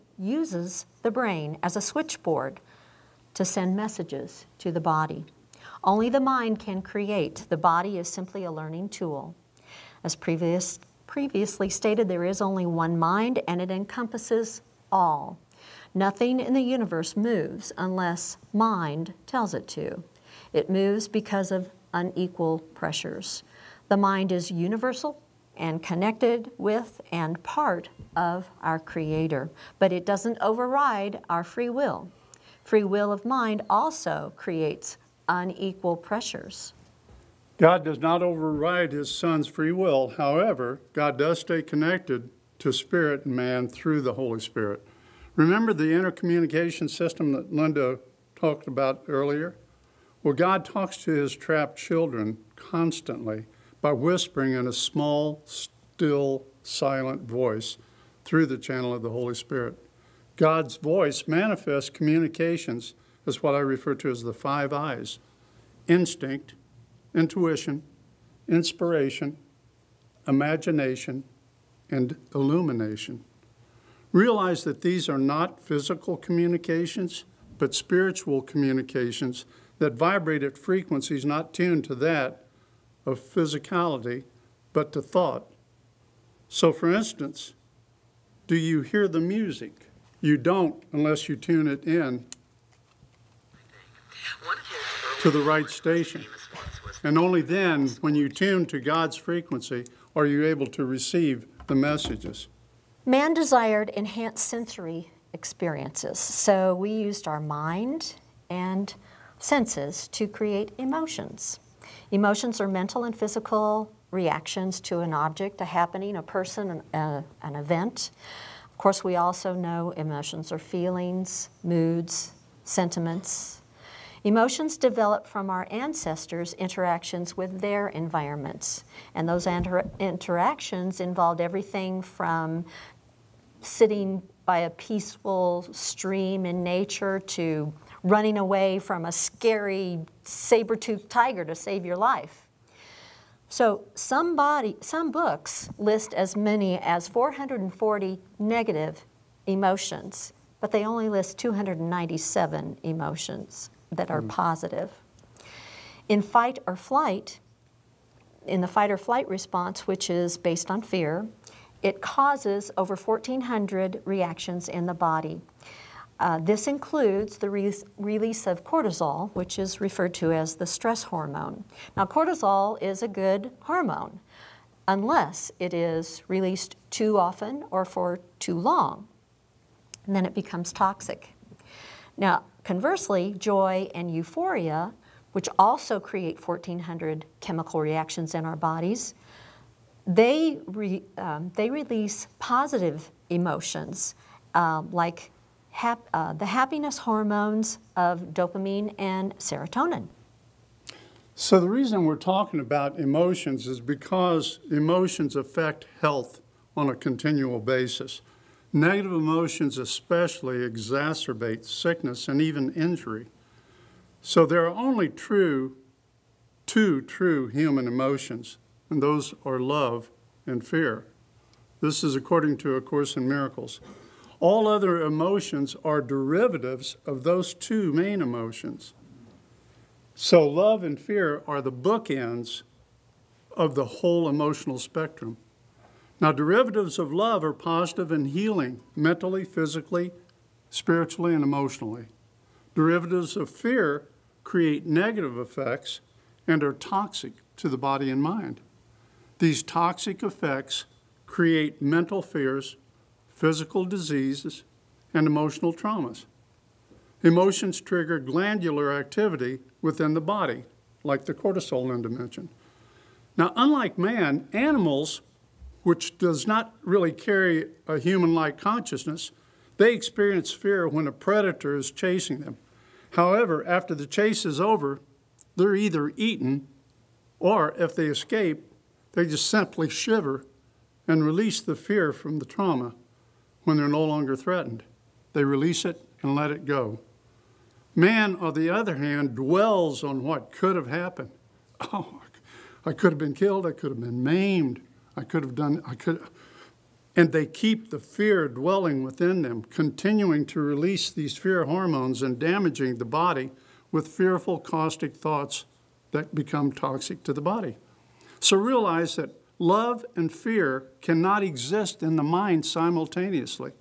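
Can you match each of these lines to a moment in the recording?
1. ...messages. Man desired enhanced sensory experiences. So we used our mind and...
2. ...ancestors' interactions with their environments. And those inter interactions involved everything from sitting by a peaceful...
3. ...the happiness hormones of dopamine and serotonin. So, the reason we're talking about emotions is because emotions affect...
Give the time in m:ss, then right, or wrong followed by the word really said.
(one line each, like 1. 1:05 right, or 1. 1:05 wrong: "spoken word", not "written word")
1. 1:41 right
2. 2:05 right
3. 3:16 right.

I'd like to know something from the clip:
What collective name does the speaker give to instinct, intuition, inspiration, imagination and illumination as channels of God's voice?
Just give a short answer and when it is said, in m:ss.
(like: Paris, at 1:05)
The five eyes, at 1:04.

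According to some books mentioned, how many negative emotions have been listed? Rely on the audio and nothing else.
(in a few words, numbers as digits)
440.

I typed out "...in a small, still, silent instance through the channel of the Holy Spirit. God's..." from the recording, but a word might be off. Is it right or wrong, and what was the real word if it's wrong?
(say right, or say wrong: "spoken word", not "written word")
wrong: "voice", not "instance".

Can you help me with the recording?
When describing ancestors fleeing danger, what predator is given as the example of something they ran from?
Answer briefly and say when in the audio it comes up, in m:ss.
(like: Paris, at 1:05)
Saber-toothed tiger, at 2:20.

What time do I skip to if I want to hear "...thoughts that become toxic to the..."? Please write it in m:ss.
5:05.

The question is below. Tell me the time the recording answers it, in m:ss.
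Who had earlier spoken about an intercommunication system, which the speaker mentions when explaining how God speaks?
0:47.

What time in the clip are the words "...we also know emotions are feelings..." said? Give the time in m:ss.
1:59.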